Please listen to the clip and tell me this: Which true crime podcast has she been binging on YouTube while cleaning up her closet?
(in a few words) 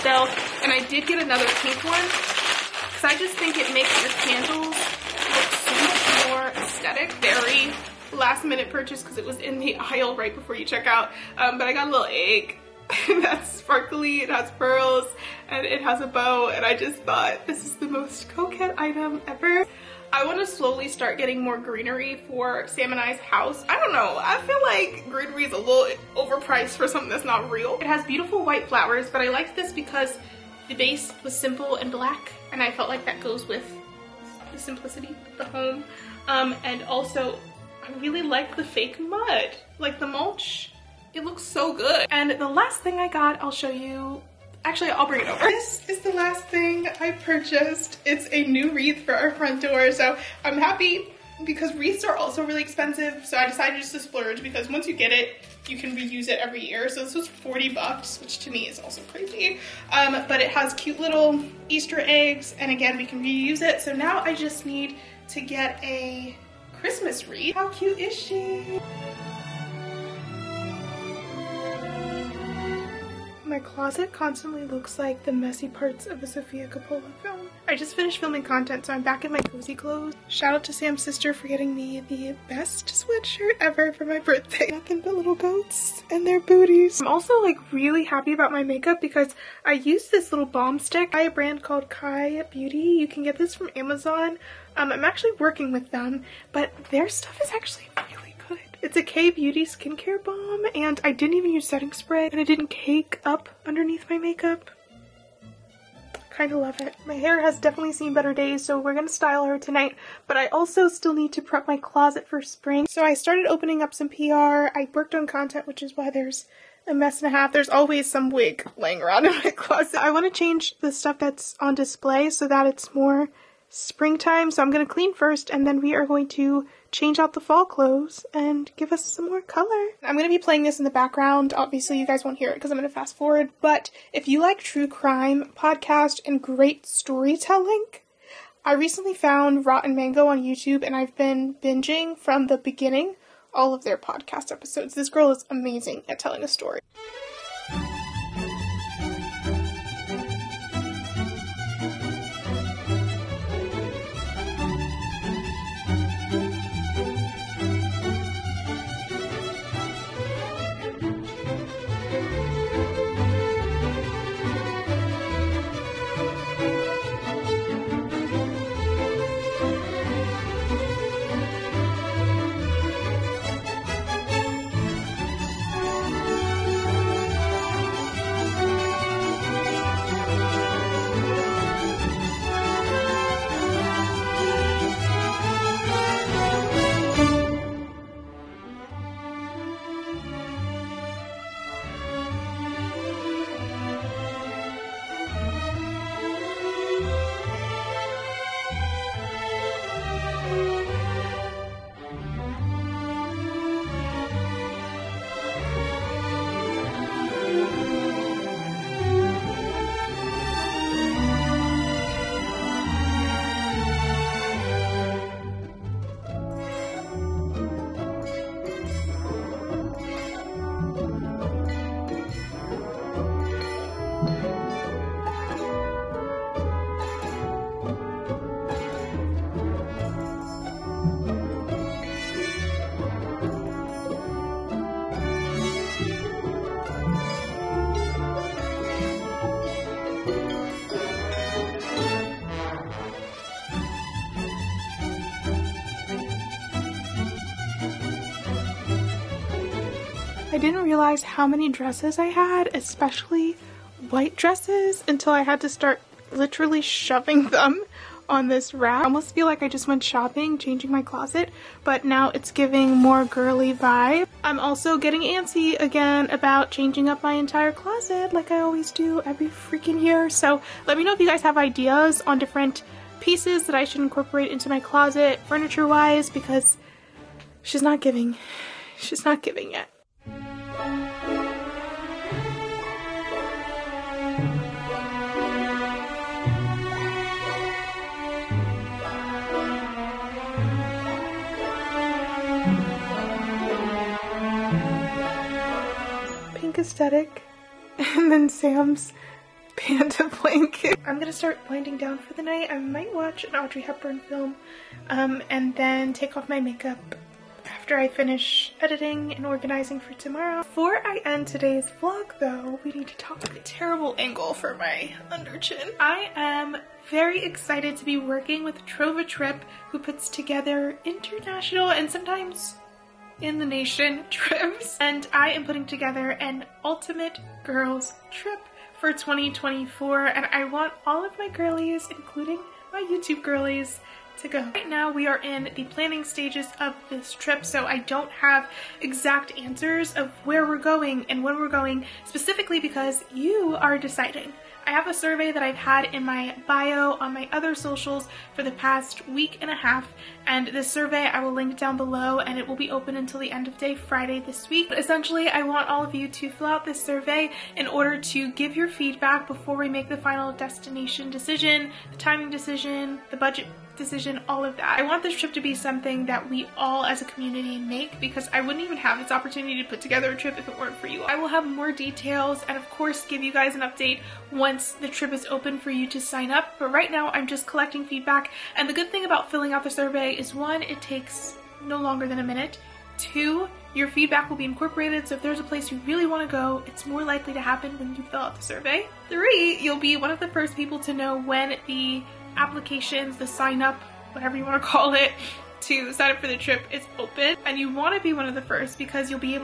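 Rotten Mango.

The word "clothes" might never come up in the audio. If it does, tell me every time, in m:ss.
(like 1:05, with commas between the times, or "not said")
1:19, 2:07.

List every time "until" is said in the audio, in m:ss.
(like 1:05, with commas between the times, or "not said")
4:15, 5:53.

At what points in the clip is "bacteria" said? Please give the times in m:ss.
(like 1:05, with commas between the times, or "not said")
not said.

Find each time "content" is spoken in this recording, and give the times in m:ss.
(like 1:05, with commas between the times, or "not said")
1:18, 1:55.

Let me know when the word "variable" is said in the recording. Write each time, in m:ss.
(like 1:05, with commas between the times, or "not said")
not said.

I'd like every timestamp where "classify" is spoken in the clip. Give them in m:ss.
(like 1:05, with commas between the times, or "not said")
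not said.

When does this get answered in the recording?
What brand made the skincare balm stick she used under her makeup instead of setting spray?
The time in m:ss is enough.
1:31.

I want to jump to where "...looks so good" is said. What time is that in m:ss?
0:41.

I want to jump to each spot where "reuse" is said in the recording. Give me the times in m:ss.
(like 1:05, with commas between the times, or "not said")
0:55, 1:03.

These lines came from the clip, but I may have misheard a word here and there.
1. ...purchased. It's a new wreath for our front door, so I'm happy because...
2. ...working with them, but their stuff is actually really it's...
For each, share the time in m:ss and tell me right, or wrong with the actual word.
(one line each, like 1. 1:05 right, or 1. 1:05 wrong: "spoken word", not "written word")
1. 0:47 right
2. 1:35 right.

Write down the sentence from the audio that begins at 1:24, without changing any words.
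Nothing but little goats and their booties.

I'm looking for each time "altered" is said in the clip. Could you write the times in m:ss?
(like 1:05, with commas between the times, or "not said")
not said.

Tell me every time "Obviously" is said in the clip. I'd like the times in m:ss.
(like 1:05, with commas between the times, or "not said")
2:11.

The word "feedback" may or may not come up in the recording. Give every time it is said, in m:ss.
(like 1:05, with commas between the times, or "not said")
5:58, 6:18, 6:24.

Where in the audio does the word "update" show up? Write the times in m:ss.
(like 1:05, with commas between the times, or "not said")
6:13.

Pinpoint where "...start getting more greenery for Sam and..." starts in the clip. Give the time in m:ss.
0:20.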